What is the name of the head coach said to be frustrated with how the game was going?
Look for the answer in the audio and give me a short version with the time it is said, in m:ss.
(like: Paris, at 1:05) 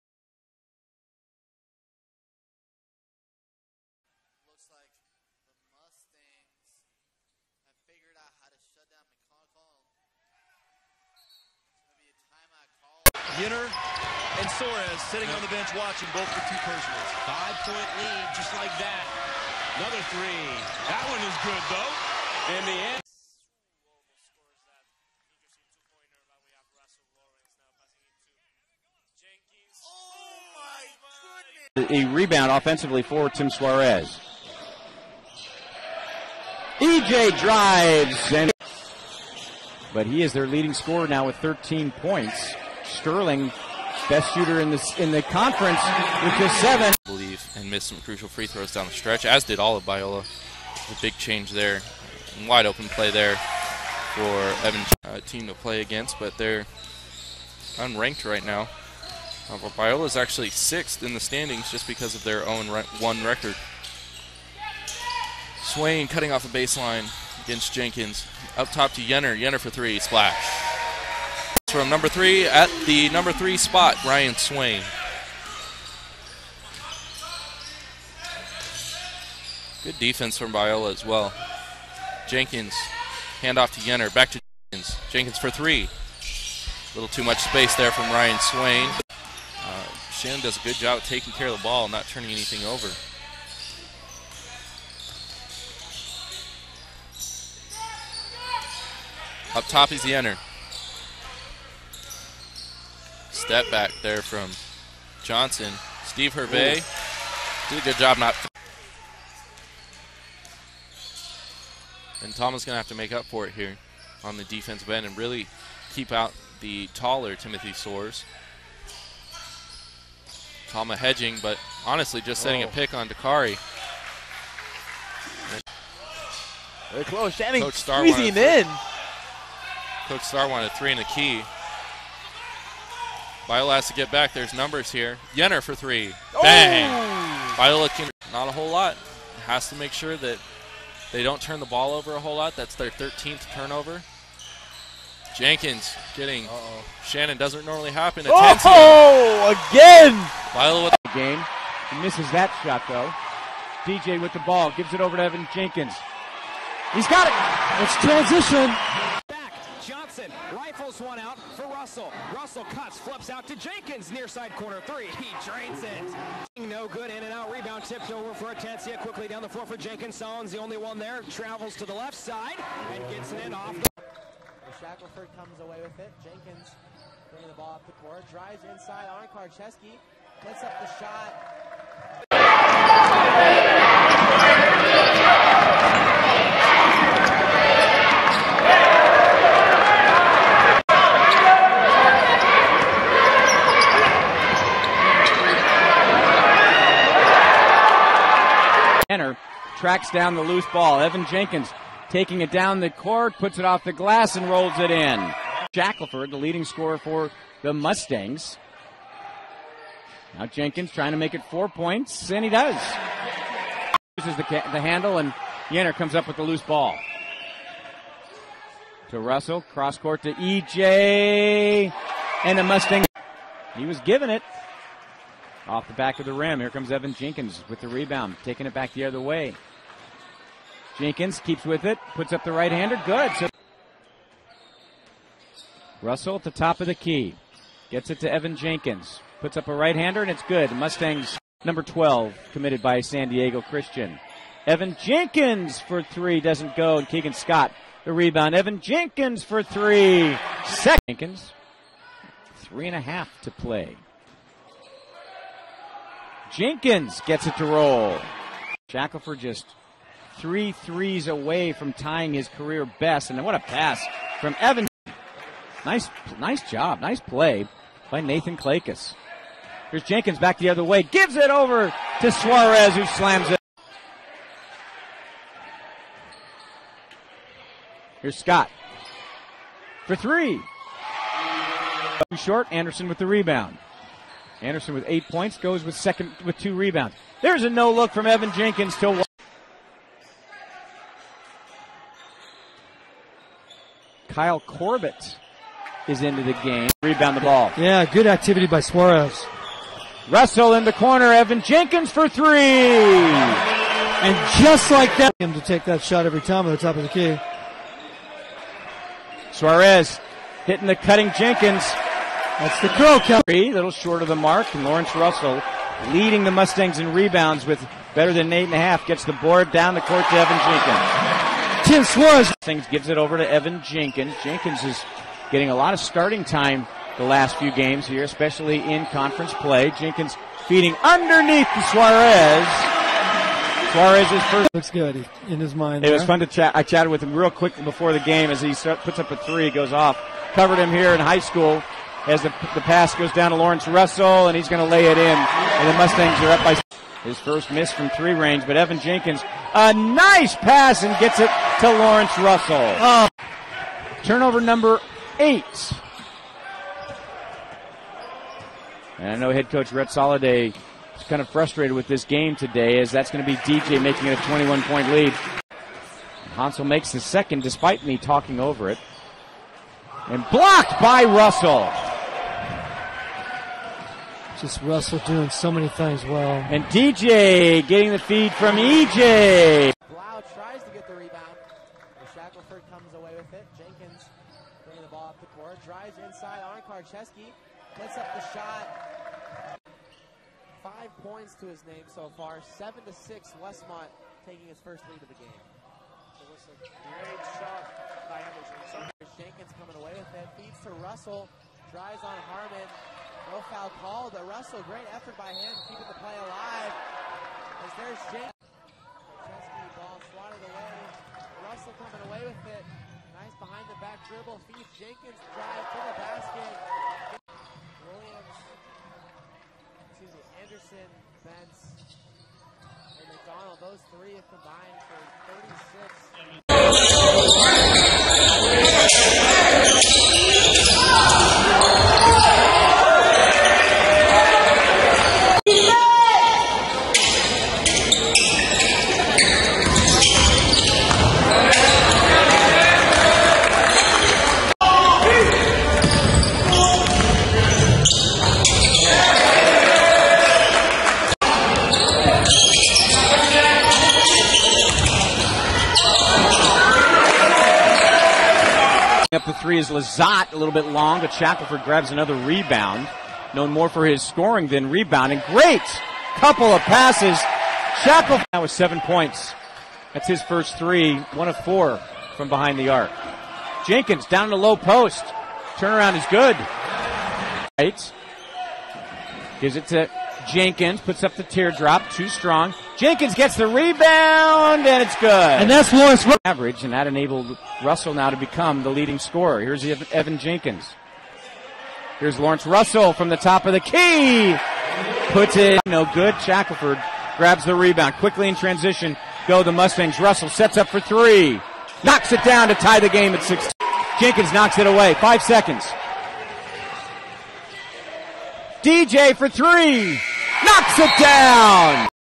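Red Soliday, at 5:59.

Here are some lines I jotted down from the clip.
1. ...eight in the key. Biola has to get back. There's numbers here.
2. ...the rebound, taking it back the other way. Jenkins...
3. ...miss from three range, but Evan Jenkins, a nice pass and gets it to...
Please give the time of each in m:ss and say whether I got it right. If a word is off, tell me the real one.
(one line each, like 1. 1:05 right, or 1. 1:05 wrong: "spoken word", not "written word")
1. 2:10 wrong: "three", not "eight"
2. 3:47 right
3. 5:47 right.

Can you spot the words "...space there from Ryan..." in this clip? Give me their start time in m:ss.
1:27.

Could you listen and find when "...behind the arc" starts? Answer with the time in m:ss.
7:52.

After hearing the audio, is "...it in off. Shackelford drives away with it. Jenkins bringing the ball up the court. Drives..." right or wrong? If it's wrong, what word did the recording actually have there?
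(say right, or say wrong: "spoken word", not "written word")
wrong: "comes", not "drives".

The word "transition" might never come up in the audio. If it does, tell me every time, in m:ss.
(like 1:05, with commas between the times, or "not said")
2:38, 8:18.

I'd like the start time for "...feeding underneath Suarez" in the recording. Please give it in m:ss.
5:30.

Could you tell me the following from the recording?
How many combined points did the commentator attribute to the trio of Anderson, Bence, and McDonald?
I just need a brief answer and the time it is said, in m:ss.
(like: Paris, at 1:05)
36, at 7:06.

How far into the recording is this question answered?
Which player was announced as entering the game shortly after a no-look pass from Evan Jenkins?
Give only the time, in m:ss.
4:54.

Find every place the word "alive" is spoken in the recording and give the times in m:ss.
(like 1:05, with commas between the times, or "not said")
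6:46.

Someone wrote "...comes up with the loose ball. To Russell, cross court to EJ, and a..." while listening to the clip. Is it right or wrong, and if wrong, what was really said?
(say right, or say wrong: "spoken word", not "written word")
right.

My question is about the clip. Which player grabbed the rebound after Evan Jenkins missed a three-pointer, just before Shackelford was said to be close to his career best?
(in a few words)
Keegan Scott.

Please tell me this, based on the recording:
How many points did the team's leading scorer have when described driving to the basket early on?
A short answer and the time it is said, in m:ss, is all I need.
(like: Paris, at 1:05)
13, at 0:41.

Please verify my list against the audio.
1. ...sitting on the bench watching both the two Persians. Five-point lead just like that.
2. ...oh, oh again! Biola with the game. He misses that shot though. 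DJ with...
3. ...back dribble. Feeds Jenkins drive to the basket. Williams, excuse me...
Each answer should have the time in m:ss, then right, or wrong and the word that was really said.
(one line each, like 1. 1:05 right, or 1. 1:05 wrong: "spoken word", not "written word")
1. 0:15 right
2. 2:28 right
3. 6:53 right.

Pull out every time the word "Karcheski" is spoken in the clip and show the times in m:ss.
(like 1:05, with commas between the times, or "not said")
2:59, 6:26.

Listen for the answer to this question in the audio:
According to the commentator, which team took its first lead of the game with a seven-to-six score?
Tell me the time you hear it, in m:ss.
6:33.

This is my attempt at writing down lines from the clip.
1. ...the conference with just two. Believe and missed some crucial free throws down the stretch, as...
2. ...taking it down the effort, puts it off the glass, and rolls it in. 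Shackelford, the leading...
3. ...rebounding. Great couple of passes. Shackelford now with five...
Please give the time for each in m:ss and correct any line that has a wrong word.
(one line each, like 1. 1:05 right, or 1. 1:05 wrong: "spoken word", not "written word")
1. 0:45 wrong: "seven", not "two"
2. 3:22 wrong: "court", not "effort"
3. 7:44 wrong: "seven", not "five".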